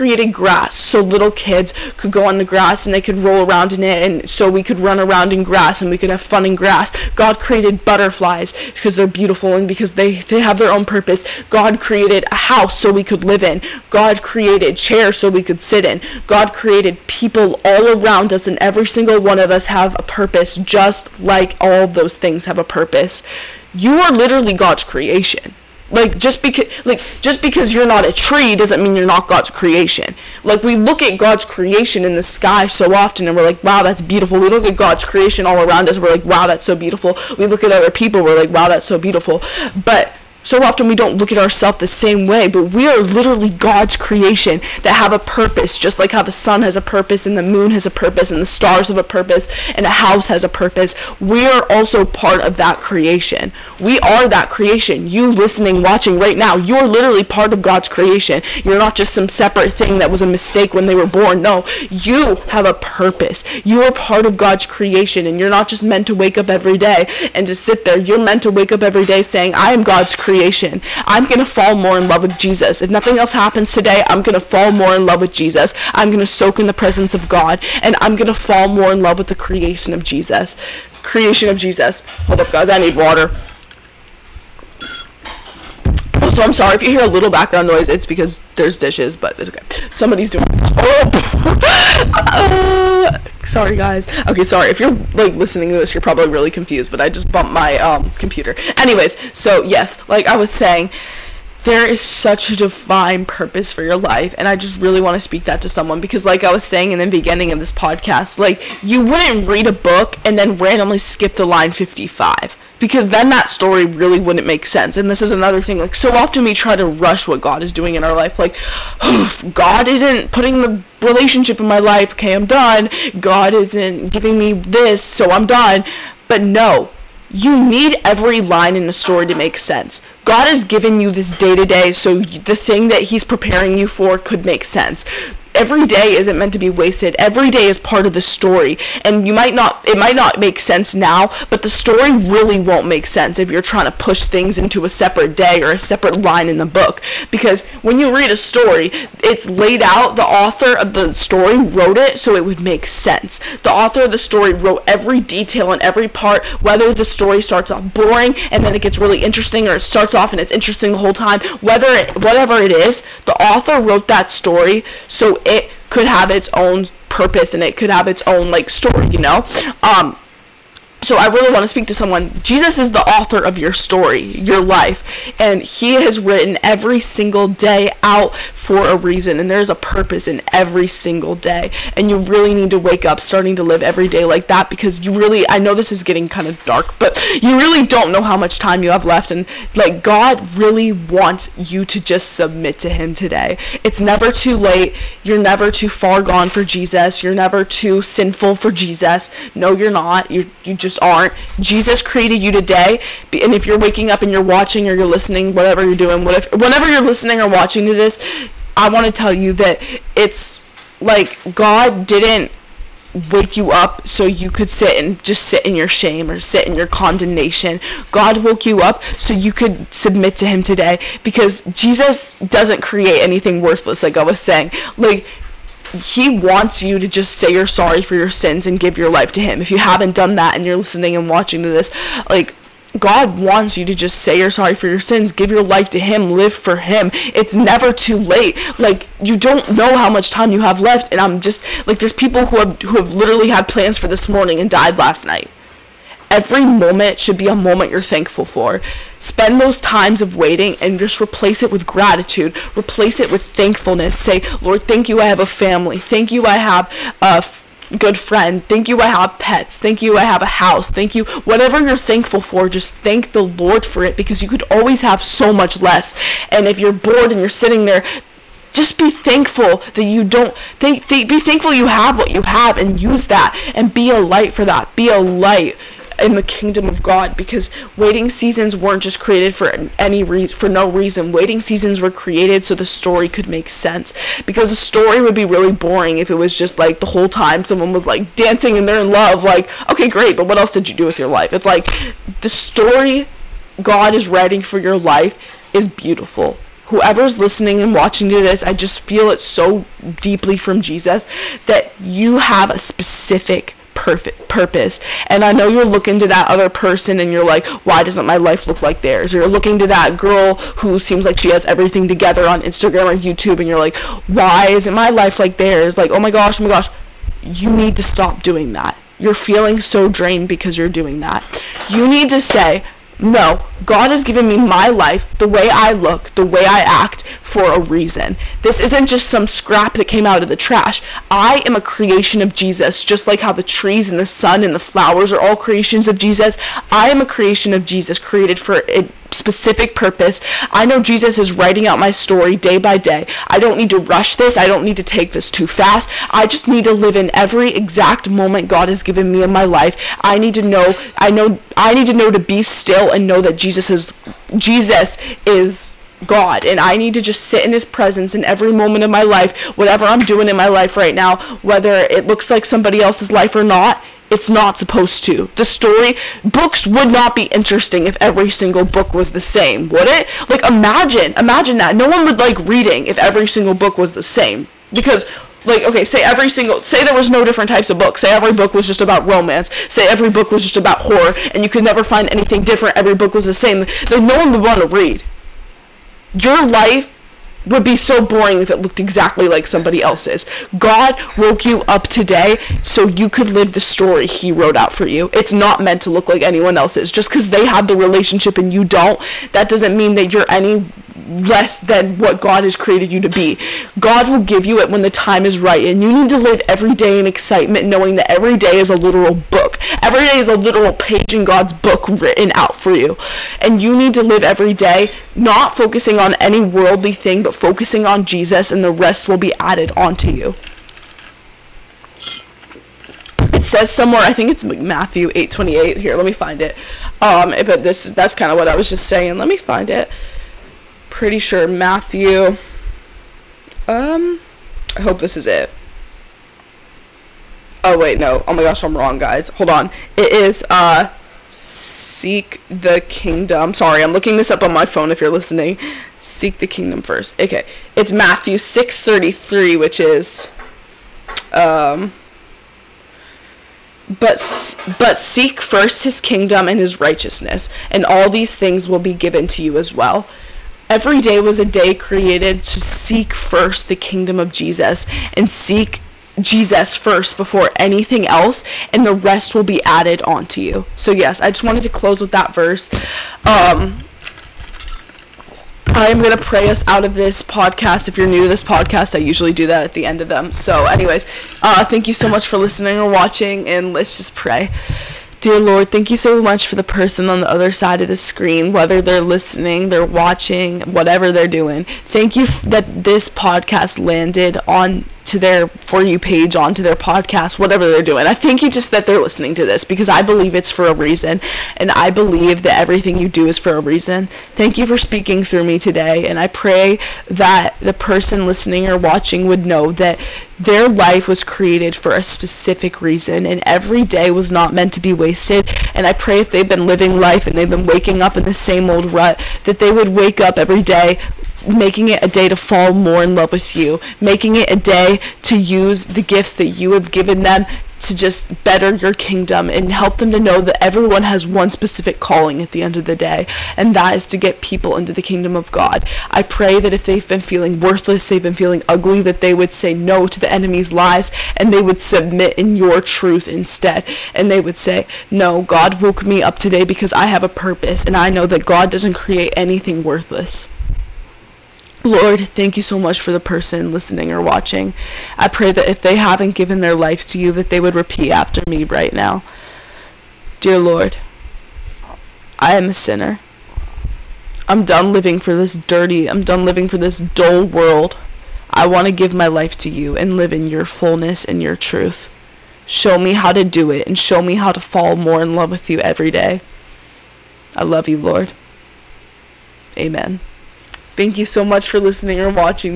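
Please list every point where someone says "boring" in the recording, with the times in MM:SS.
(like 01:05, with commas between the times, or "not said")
02:37, 04:45, 06:28.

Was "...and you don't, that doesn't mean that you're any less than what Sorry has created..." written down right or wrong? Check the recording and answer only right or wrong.
wrong.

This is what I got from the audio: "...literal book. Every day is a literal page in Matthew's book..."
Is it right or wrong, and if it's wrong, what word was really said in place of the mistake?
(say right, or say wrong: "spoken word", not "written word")
wrong: "God", not "Matthew".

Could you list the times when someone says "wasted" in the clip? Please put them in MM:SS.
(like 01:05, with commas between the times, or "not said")
02:16, 08:35.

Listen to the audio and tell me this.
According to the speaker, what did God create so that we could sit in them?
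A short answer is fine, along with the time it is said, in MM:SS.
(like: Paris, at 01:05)
chairs, at 00:14.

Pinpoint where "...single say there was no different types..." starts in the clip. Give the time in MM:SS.
06:16.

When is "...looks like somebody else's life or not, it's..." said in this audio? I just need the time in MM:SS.
06:02.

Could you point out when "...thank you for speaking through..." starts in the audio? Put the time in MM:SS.
08:24.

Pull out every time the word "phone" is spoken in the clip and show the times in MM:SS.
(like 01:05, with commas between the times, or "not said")
07:24.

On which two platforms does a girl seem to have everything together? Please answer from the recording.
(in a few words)
Instagram or YouTube.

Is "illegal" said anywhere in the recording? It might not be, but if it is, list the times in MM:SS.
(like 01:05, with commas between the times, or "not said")
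not said.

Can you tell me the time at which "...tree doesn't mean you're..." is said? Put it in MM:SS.
00:28.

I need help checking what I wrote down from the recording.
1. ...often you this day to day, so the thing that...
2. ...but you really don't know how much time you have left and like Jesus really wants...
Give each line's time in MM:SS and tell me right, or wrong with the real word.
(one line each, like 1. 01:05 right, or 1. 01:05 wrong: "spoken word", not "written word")
1. 02:10 wrong: "given", not "often"
2. 03:06 wrong: "God", not "Jesus".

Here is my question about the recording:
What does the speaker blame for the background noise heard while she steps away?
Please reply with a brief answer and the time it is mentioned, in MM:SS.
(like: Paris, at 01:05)
dishes, at 01:28.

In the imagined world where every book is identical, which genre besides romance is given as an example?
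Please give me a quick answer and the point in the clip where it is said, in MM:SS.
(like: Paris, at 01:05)
horror, at 06:20.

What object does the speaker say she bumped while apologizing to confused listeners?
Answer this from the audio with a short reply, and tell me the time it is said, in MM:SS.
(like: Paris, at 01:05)
computer, at 01:38.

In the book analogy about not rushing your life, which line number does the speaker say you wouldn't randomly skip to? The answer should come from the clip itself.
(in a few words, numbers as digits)
55.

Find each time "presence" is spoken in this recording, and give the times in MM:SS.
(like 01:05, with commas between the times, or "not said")
01:16, 05:57.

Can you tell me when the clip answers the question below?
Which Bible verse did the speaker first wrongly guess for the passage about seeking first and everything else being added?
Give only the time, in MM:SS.
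07:04.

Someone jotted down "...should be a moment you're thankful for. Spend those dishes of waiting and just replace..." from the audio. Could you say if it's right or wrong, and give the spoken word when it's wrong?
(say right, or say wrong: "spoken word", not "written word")
wrong: "times", not "dishes".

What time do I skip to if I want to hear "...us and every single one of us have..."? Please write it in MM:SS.
00:18.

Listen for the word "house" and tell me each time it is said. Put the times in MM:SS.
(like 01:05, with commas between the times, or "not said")
00:12, 00:49, 04:20.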